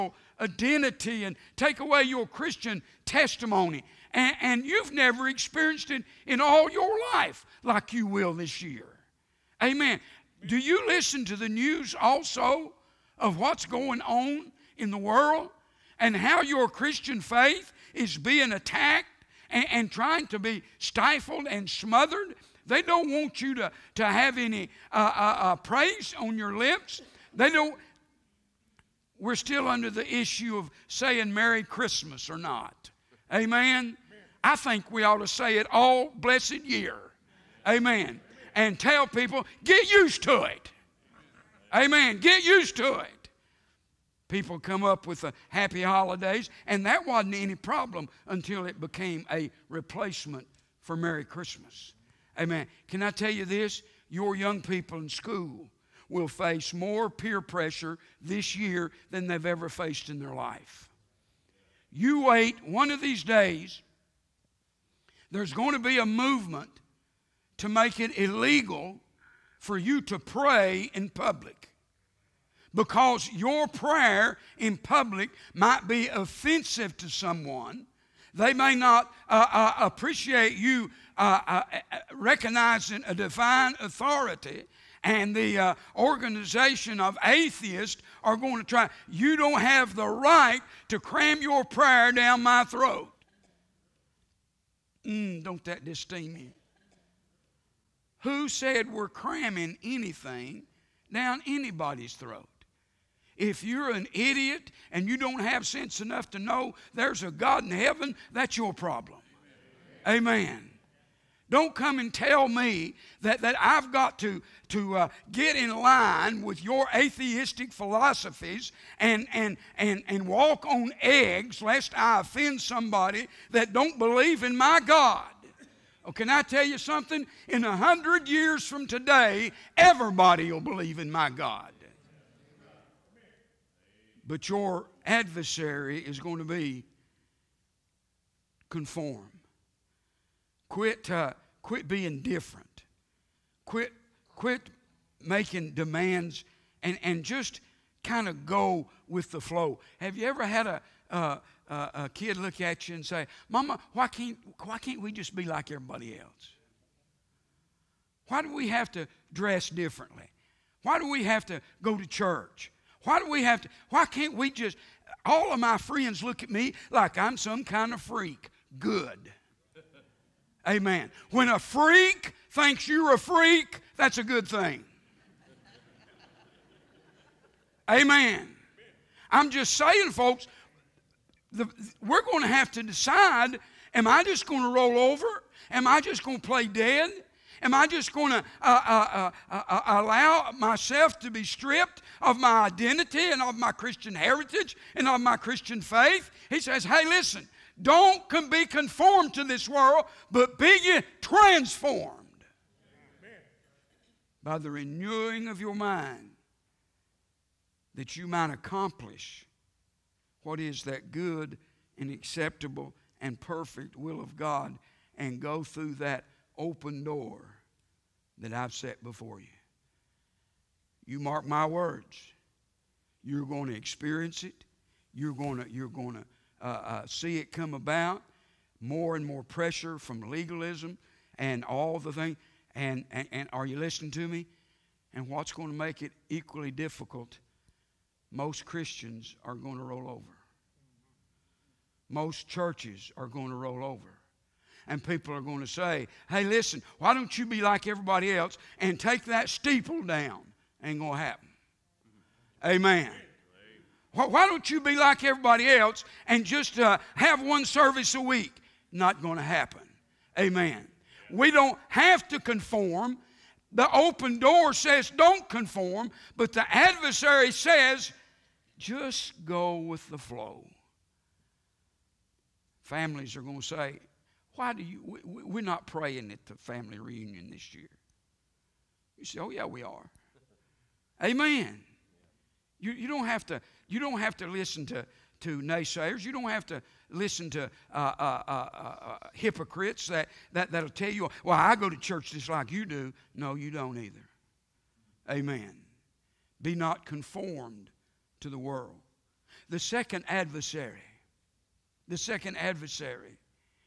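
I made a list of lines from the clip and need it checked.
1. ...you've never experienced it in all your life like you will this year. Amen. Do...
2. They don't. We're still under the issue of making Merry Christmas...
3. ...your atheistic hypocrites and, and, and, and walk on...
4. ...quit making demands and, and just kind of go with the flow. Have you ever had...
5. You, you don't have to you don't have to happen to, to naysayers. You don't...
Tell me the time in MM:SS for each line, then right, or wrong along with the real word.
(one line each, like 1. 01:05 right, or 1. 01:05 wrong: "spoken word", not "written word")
1. 00:04 right
2. 00:27 wrong: "saying", not "making"
3. 01:56 wrong: "philosophies", not "hypocrites"
4. 02:24 right
5. 04:42 wrong: "listen", not "happen".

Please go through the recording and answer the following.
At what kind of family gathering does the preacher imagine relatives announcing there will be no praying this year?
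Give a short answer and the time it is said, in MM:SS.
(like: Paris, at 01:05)
Family reunion, at 04:36.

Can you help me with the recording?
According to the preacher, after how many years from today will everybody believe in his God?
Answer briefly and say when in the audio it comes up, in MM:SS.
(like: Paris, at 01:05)
100, at 02:07.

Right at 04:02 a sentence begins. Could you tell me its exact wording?
Most churches are going to roll over.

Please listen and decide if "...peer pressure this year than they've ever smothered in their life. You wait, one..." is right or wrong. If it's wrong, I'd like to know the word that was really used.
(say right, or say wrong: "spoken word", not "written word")
wrong: "faced", not "smothered".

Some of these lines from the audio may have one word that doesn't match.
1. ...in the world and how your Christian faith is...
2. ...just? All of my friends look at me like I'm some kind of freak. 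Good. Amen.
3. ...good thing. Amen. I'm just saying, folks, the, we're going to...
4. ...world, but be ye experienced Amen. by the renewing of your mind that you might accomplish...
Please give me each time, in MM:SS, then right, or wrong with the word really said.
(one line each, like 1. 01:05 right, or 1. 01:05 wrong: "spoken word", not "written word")
1. 00:14 right
2. 02:44 right
3. 02:54 right
4. 03:19 wrong: "transformed", not "experienced".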